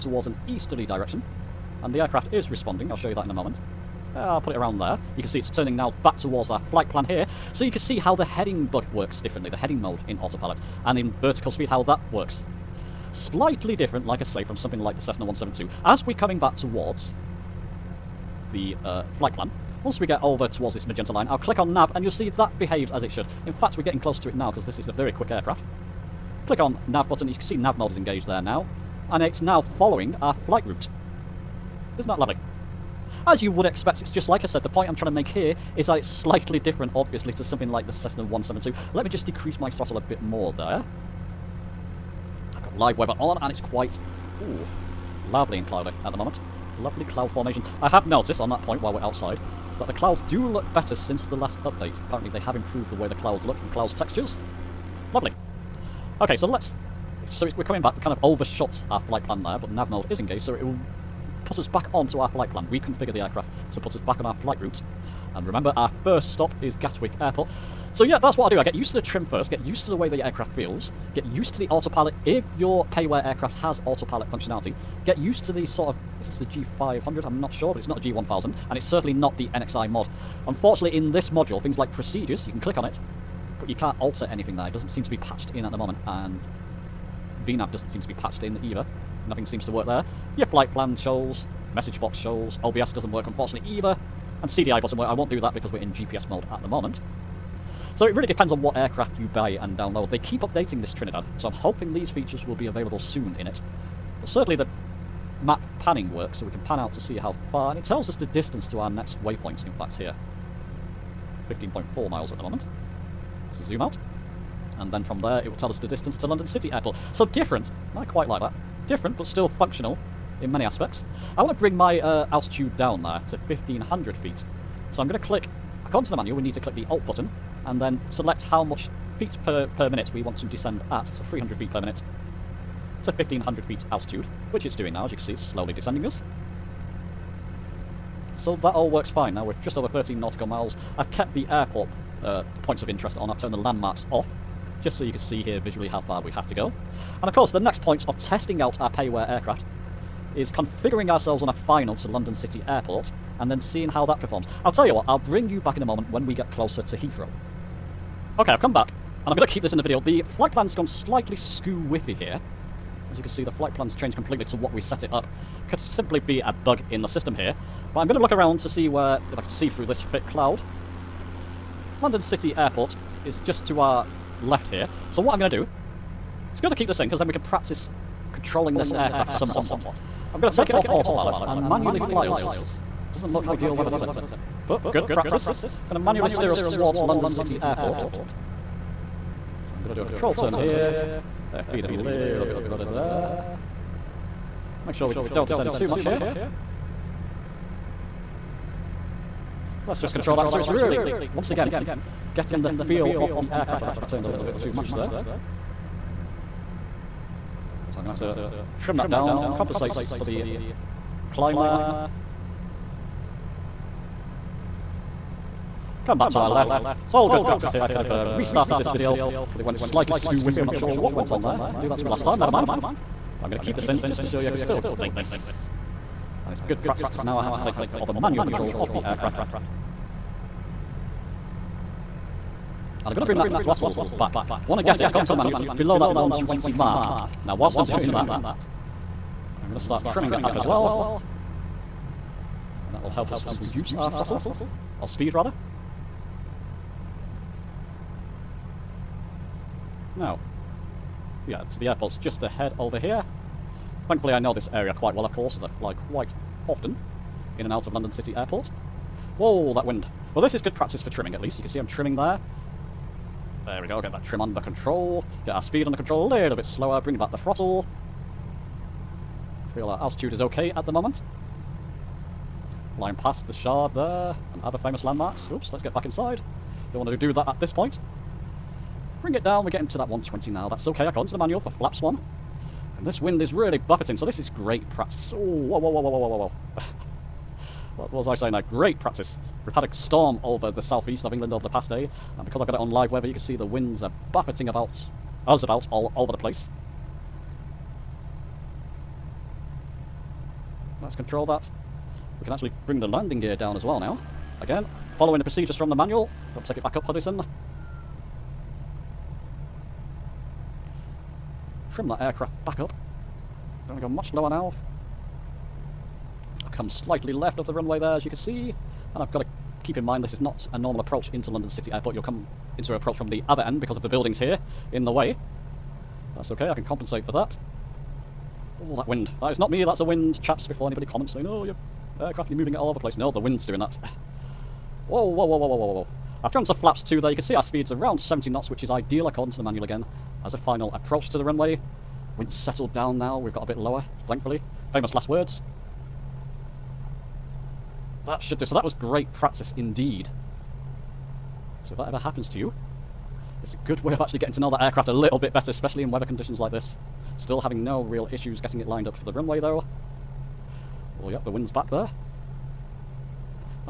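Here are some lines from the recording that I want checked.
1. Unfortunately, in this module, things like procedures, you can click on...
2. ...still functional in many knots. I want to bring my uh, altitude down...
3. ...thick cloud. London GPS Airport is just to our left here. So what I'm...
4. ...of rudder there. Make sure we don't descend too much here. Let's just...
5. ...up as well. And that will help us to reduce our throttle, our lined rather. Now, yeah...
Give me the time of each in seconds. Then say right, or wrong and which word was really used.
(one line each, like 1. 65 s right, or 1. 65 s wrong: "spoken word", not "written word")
1. 80 s right
2. 119 s wrong: "aspects", not "knots"
3. 170 s wrong: "City", not "GPS"
4. 192 s right
5. 240 s wrong: "speed", not "lined".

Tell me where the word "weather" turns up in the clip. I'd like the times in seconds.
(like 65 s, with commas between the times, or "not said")
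42 s, 183 s, 293 s, 356 s.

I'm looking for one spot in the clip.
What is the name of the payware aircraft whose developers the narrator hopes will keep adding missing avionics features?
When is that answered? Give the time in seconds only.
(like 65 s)
100 s.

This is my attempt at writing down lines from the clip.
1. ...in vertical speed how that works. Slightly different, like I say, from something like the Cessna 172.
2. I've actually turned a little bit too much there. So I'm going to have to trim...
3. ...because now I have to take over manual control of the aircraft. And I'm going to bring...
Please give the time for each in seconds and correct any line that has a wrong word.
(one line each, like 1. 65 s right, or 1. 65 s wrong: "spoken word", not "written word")
1. 10 s right
2. 203 s right
3. 227 s right.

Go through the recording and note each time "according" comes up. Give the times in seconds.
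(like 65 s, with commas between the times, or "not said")
125 s, 235 s, 281 s, 339 s.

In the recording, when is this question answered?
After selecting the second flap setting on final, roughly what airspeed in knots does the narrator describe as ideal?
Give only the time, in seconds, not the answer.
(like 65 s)
338 s.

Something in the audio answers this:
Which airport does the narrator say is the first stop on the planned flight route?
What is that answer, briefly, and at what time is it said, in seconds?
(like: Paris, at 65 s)
Gatwick Airport, at 66 s.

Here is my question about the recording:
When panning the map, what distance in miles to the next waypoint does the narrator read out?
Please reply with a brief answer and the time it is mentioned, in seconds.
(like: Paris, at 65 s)
15.4 miles, at 111 s.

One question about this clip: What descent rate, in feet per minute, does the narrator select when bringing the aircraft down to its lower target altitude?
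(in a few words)
300.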